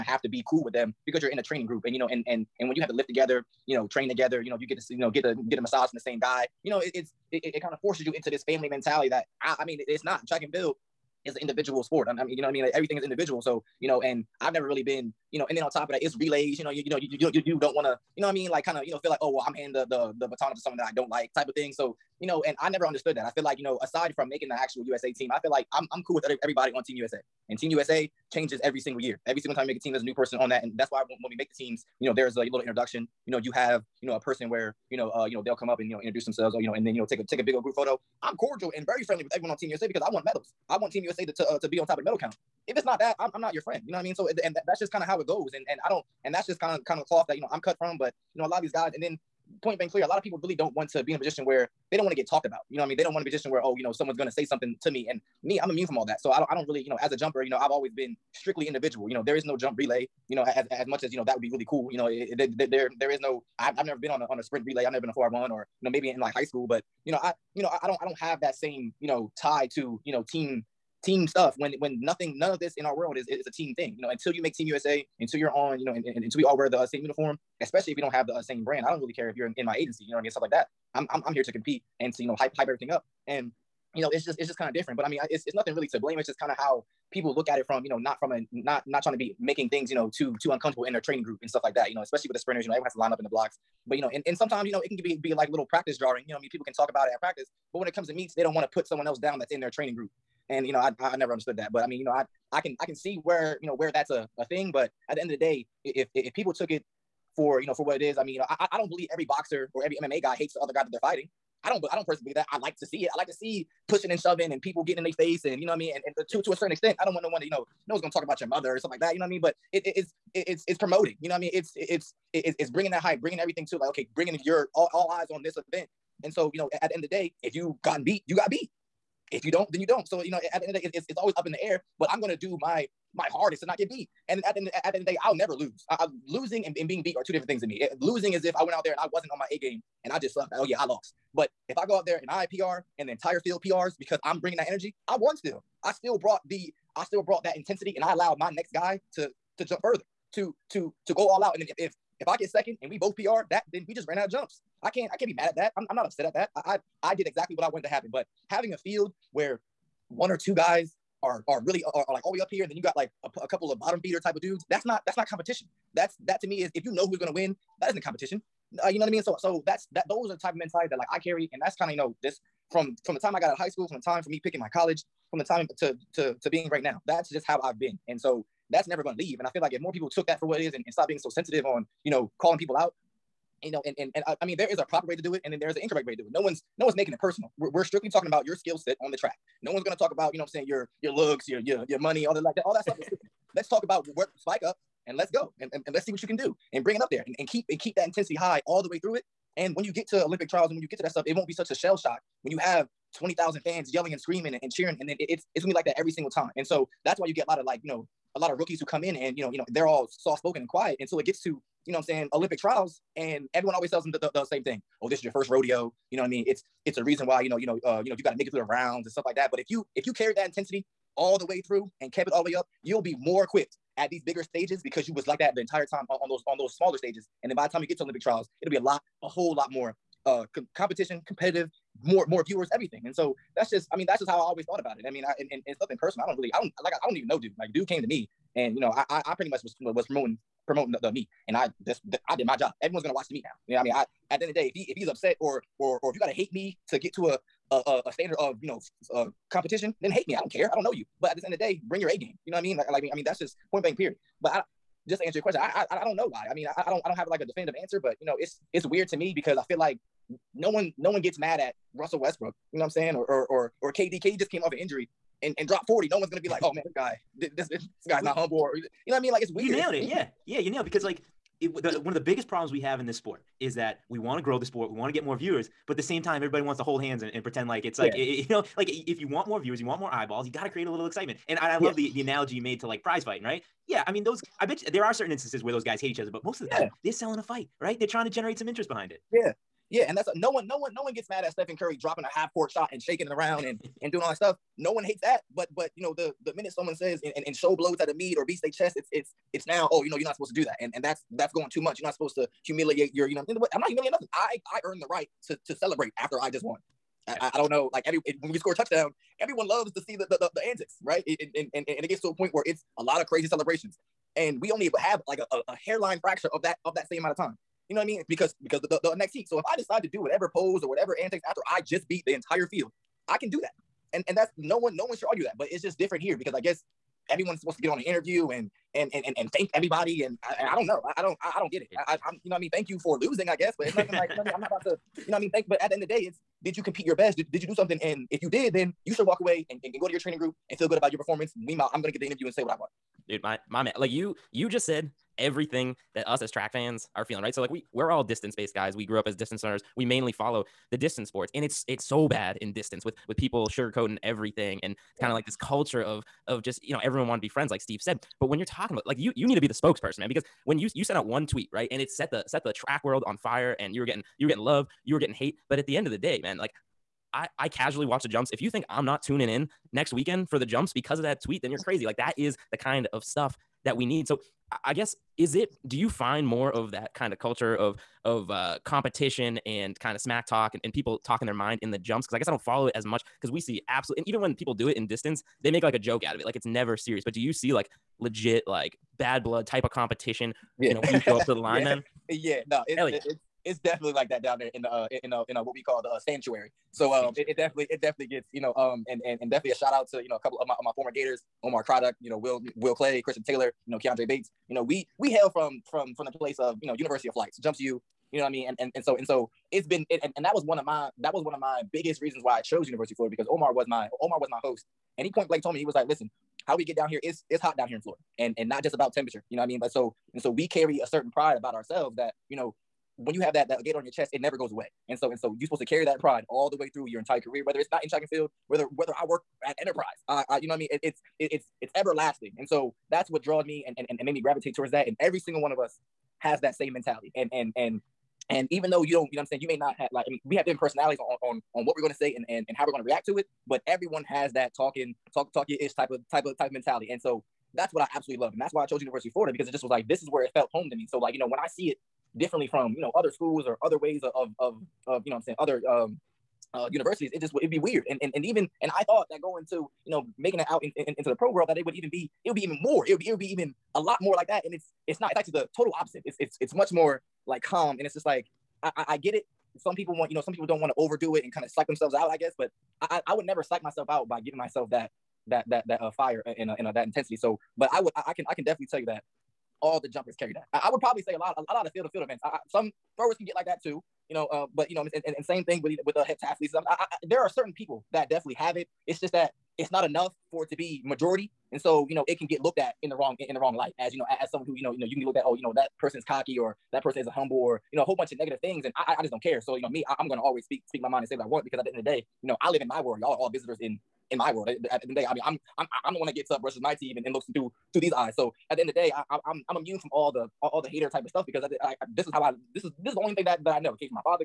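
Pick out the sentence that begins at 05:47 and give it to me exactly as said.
So like we we're all distance based guys.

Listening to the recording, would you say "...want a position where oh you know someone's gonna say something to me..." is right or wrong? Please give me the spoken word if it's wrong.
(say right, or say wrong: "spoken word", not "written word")
right.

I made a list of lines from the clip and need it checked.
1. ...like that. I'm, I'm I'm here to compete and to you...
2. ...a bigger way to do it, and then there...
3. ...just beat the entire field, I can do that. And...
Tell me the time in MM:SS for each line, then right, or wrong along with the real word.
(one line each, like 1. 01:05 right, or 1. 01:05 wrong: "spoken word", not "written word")
1. 01:20 right
2. 03:04 wrong: "proper", not "bigger"
3. 05:21 right.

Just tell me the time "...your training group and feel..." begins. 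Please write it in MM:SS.
05:40.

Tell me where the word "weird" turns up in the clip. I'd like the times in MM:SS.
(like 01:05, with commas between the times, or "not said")
04:18, 04:29, 07:37.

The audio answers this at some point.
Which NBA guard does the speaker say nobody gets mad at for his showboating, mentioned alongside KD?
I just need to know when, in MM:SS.
04:21.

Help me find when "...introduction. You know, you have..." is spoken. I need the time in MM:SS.
00:32.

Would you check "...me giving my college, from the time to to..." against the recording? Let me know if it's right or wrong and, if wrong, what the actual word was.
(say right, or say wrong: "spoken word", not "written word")
wrong: "picking", not "giving".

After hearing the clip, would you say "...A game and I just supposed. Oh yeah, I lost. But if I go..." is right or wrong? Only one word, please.
wrong.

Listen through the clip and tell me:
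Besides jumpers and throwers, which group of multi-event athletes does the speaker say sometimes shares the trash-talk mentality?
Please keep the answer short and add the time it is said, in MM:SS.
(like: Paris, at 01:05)
heptathletes, at 08:06.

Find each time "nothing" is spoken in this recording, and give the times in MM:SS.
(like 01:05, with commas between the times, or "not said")
01:12, 01:25, 03:55, 05:04, 05:33.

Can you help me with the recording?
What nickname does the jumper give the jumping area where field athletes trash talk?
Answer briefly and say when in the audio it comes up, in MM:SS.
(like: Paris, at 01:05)
sanctuary, at 06:36.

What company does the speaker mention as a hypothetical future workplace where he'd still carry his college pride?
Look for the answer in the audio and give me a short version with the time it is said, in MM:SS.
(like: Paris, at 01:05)
Enterprise, at 07:09.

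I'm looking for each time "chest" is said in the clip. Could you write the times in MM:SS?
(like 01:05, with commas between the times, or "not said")
04:58, 07:04.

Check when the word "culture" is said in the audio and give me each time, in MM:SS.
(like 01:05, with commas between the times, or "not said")
05:55, 06:17.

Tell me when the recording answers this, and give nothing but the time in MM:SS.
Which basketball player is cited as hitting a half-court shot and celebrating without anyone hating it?
04:51.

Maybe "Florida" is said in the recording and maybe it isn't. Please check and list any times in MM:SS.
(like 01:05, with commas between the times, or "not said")
06:53, 06:58, 07:29.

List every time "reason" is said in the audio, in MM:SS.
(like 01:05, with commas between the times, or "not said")
03:37, 06:52.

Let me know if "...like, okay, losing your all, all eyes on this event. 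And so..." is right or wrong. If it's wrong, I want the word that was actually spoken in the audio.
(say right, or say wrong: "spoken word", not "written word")
wrong: "bringing", not "losing".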